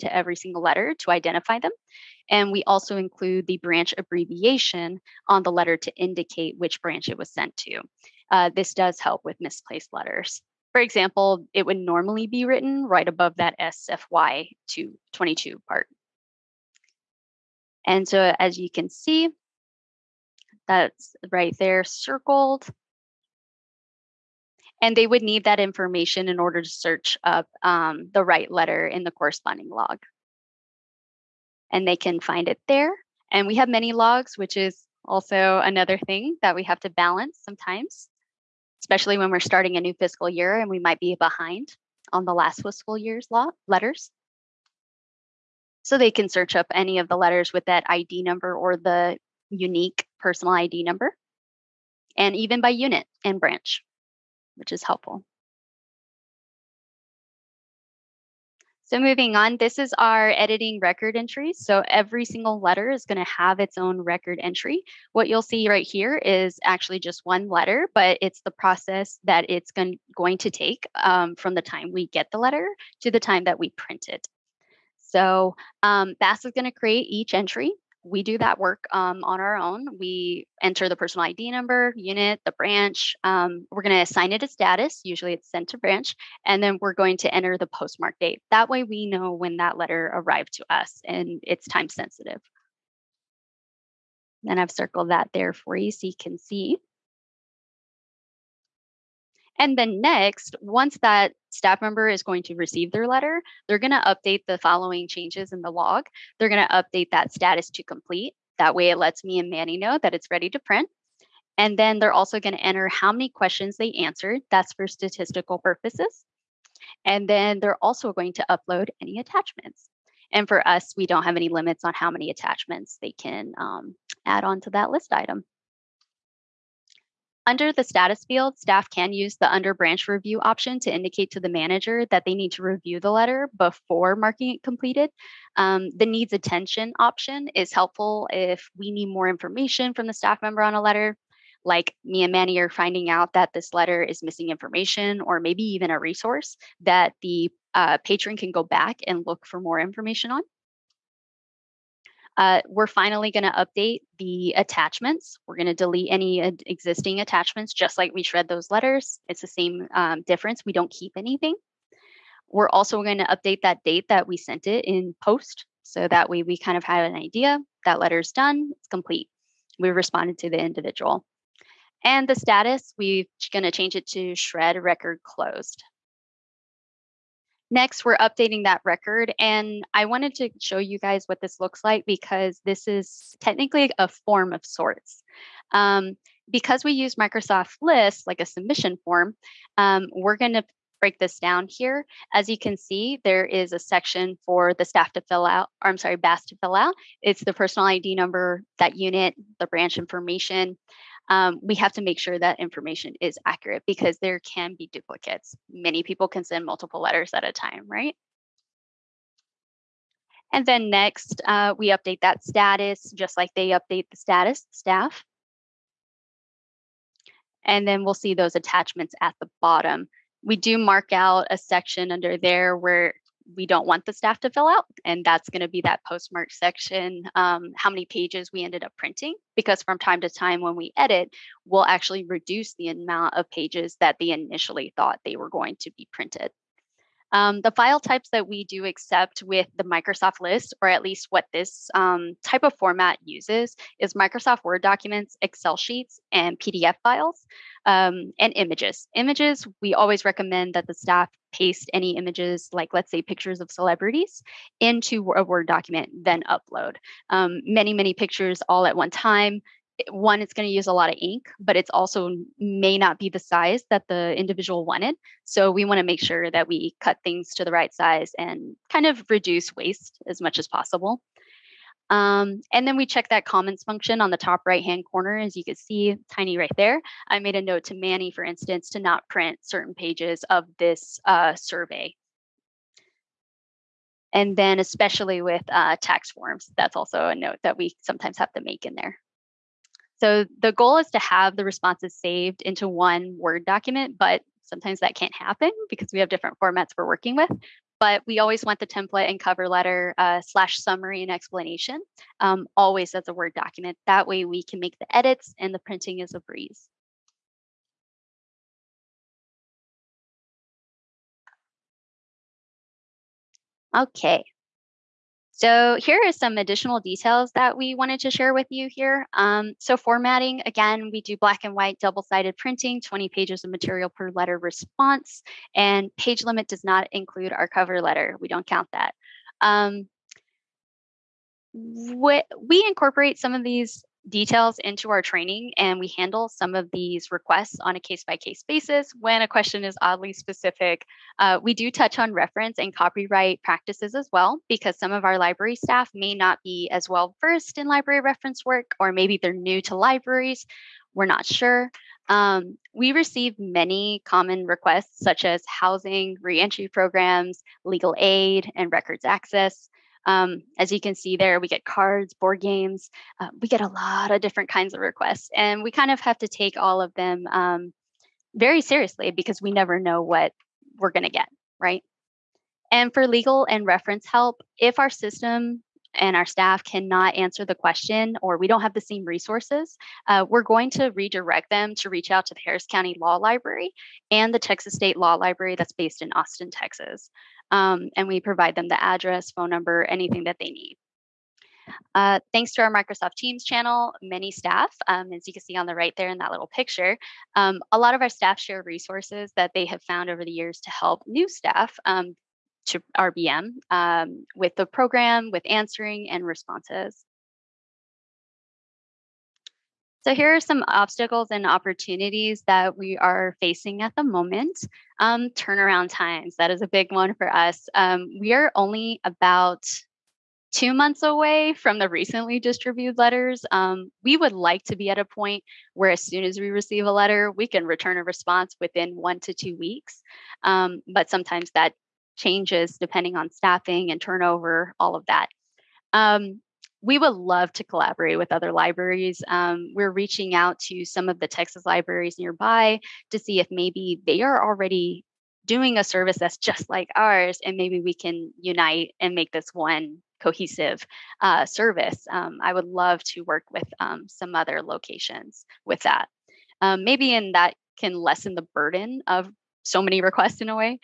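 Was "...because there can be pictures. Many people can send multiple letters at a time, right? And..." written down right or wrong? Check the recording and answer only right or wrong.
wrong.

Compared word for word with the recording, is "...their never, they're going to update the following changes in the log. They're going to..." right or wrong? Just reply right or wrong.
wrong.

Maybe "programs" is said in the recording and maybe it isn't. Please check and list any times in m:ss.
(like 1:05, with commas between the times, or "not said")
5:56, 6:44.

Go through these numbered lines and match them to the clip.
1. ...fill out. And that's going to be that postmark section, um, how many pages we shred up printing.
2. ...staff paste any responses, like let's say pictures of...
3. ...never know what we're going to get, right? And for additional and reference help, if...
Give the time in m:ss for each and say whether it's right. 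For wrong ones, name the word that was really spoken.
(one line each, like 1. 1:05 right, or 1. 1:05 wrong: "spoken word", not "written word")
1. 3:44 wrong: "ended", not "shred"
2. 4:10 wrong: "images", not "responses"
3. 6:09 wrong: "legal", not "additional".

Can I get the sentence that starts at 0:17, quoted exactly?
And so as you can see, that's right there circled.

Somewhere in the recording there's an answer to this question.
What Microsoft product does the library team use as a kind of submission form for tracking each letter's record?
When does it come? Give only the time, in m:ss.
3:07.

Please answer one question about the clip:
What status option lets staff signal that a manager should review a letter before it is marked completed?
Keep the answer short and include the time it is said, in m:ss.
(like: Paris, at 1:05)
under branch review, at 2:09.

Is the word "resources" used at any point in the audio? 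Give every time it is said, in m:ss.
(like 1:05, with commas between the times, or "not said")
2:25, 6:19, 6:38.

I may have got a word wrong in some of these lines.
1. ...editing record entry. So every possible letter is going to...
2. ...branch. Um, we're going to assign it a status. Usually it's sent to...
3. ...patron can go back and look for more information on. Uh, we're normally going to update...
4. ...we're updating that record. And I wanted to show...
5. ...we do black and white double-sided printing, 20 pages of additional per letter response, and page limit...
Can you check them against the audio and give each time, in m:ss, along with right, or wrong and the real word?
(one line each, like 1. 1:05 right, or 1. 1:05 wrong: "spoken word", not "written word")
1. 1:00 wrong: "single", not "possible"
2. 1:22 right
3. 2:28 wrong: "finally", not "normally"
4. 2:58 right
5. 5:21 wrong: "material", not "additional".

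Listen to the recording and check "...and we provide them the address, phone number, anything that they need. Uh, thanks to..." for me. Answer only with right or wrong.
right.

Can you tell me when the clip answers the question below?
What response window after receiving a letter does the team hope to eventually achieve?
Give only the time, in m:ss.
7:09.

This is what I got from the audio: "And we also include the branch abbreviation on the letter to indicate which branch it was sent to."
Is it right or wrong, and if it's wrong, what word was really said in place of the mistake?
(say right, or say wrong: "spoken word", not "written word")
right.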